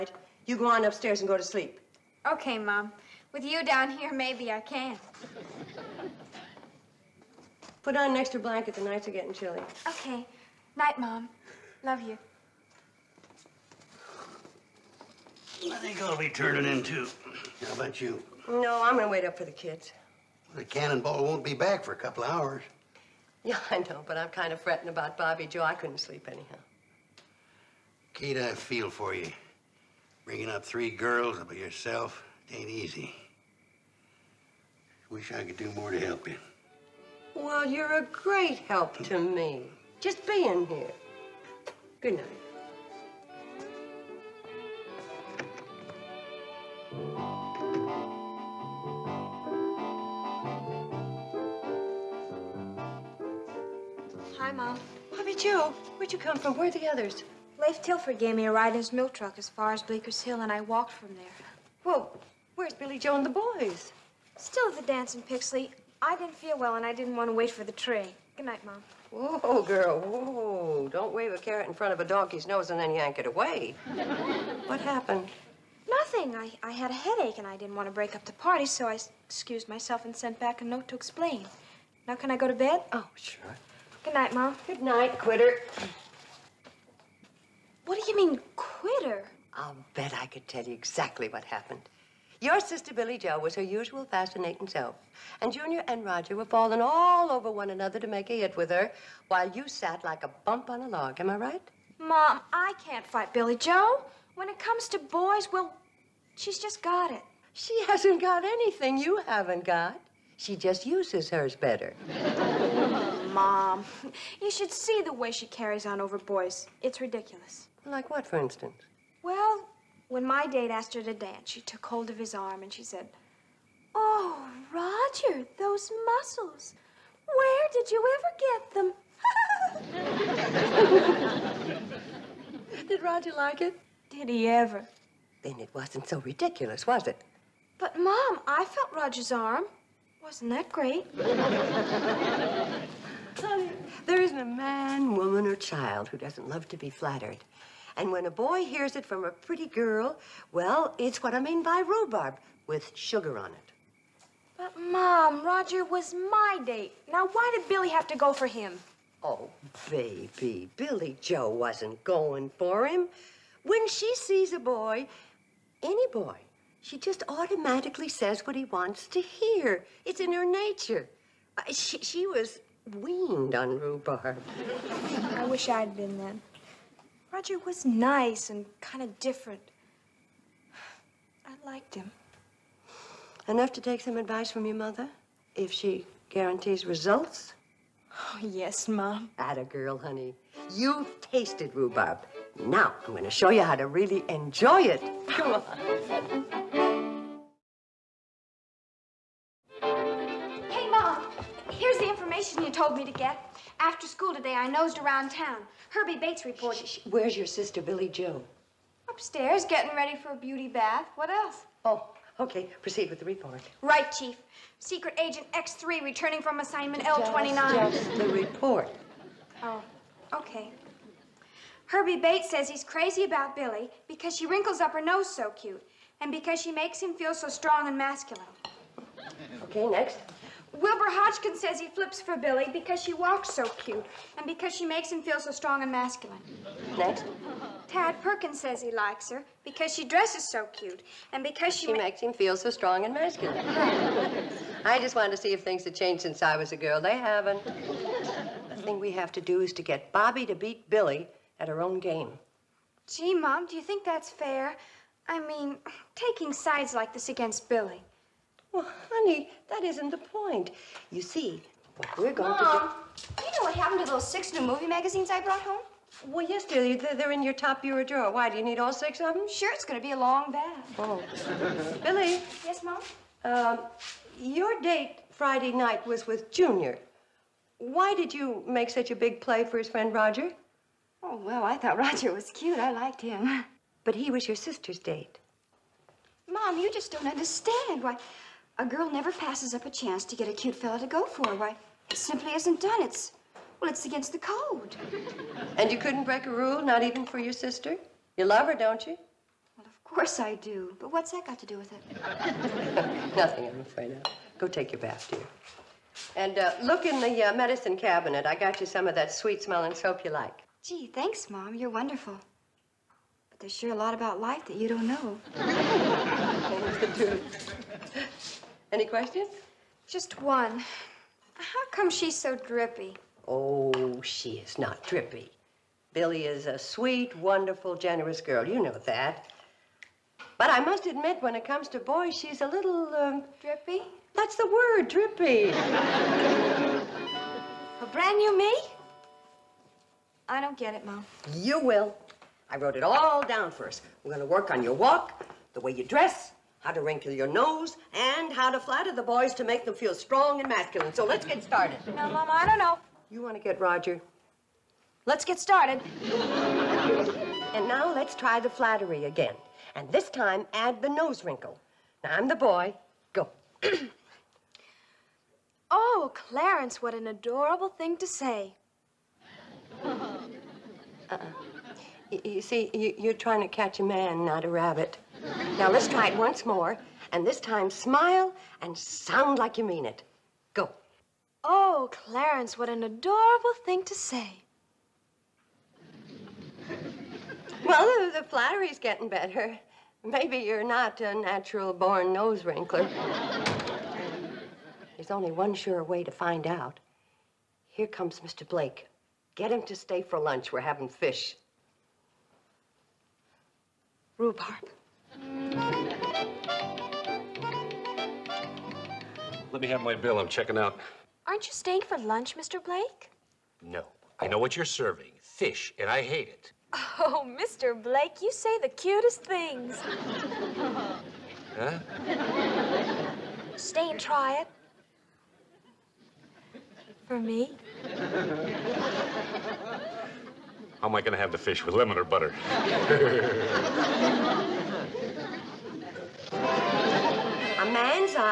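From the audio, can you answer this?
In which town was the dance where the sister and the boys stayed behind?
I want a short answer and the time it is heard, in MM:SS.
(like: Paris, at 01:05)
Pixley, at 01:05.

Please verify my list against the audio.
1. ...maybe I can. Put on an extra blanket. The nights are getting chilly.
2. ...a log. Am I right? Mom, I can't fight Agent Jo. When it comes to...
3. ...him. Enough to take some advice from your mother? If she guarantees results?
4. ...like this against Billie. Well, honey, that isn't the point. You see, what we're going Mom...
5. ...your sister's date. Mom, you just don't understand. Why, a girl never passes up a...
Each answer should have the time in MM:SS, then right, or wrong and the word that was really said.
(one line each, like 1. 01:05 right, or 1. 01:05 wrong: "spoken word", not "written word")
1. 00:04 right
2. 01:40 wrong: "Billie", not "Agent"
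3. 03:01 right
4. 04:16 right
5. 04:44 right.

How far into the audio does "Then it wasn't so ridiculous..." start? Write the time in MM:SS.
02:15.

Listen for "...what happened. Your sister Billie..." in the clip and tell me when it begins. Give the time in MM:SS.
01:31.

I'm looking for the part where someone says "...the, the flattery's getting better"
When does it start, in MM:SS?
06:28.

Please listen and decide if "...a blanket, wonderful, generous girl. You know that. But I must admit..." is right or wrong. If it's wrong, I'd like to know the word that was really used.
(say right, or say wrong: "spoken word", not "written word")
wrong: "sweet", not "blanket".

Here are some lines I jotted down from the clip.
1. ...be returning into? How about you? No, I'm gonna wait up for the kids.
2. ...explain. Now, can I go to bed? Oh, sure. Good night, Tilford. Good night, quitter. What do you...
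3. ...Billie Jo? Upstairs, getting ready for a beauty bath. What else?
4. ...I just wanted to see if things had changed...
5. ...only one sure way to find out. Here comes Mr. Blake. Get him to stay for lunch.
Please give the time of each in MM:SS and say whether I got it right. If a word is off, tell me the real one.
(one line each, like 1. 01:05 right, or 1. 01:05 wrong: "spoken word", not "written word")
1. 00:16 wrong: "turning", not "returning"
2. 01:20 wrong: "Mom", not "Tilford"
3. 03:27 right
4. 04:04 right
5. 06:35 right.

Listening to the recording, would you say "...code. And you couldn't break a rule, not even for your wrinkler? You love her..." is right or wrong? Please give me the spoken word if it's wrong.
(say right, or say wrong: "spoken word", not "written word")
wrong: "sister", not "wrinkler".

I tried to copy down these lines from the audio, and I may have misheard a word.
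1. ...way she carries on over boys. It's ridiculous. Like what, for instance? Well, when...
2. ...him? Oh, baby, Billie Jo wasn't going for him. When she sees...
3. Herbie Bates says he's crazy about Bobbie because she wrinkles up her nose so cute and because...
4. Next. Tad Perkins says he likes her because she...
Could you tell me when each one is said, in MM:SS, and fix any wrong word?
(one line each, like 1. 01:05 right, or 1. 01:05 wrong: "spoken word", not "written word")
1. 01:55 right
2. 02:38 right
3. 03:41 wrong: "Billie", not "Bobbie"
4. 03:56 right.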